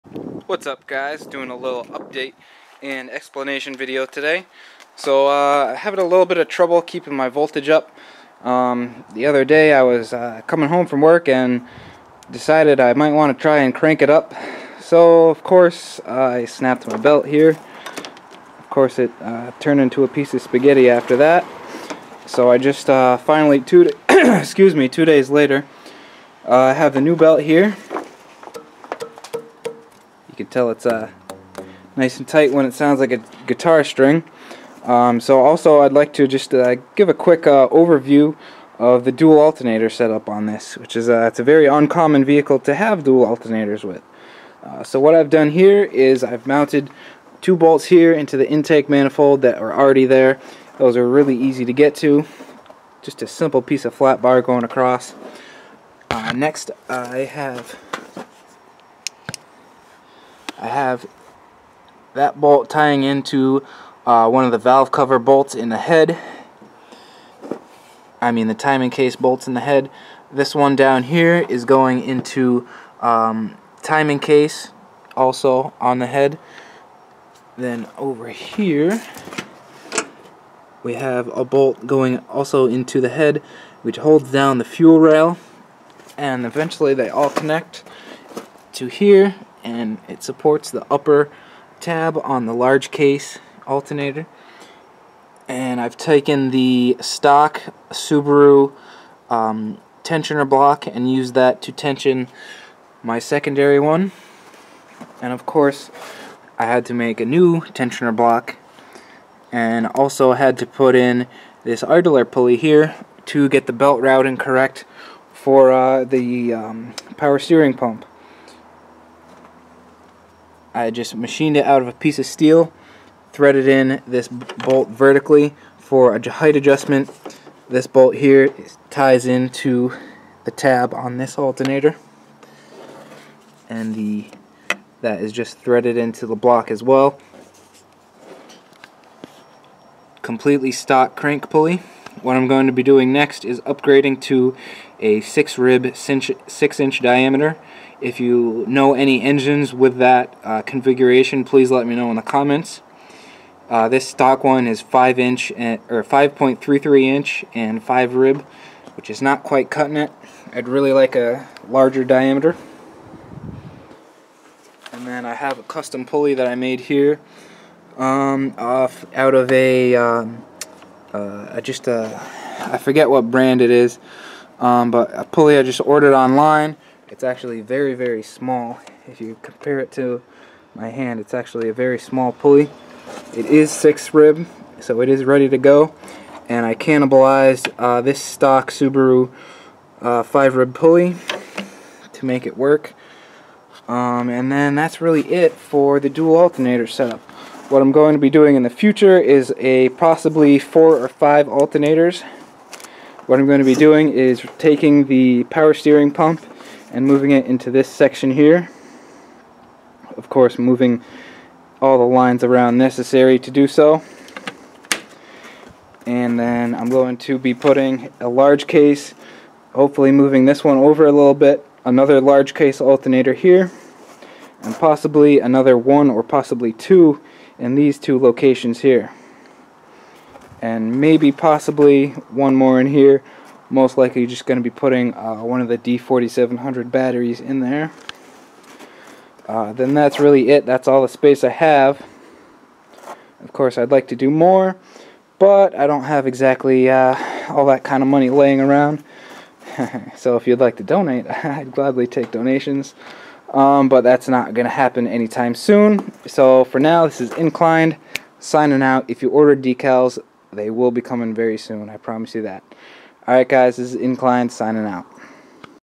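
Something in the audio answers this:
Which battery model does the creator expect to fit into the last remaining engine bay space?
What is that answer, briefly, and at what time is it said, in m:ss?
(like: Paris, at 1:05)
D4700, at 3:55.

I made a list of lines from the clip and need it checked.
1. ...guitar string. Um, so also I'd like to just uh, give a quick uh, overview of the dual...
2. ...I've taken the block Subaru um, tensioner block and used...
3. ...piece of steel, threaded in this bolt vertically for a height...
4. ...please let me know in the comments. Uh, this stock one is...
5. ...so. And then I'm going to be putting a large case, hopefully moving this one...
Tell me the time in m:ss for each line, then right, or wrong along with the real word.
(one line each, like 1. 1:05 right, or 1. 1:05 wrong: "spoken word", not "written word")
1. 0:33 right
2. 1:35 wrong: "stock", not "block"
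3. 2:01 right
4. 2:31 right
5. 3:33 right.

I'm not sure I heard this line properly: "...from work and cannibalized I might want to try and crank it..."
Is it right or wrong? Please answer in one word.
wrong.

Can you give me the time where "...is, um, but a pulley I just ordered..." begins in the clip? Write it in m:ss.
2:53.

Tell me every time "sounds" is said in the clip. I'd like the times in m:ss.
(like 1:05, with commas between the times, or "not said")
0:32.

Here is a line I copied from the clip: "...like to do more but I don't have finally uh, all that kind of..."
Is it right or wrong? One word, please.
wrong.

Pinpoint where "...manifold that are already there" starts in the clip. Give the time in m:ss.
0:48.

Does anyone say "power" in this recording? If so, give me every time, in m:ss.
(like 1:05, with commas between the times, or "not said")
1:57, 3:25.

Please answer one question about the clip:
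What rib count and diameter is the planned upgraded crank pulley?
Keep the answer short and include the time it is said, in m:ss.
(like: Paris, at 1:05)
6 rib, 6 inch, at 2:25.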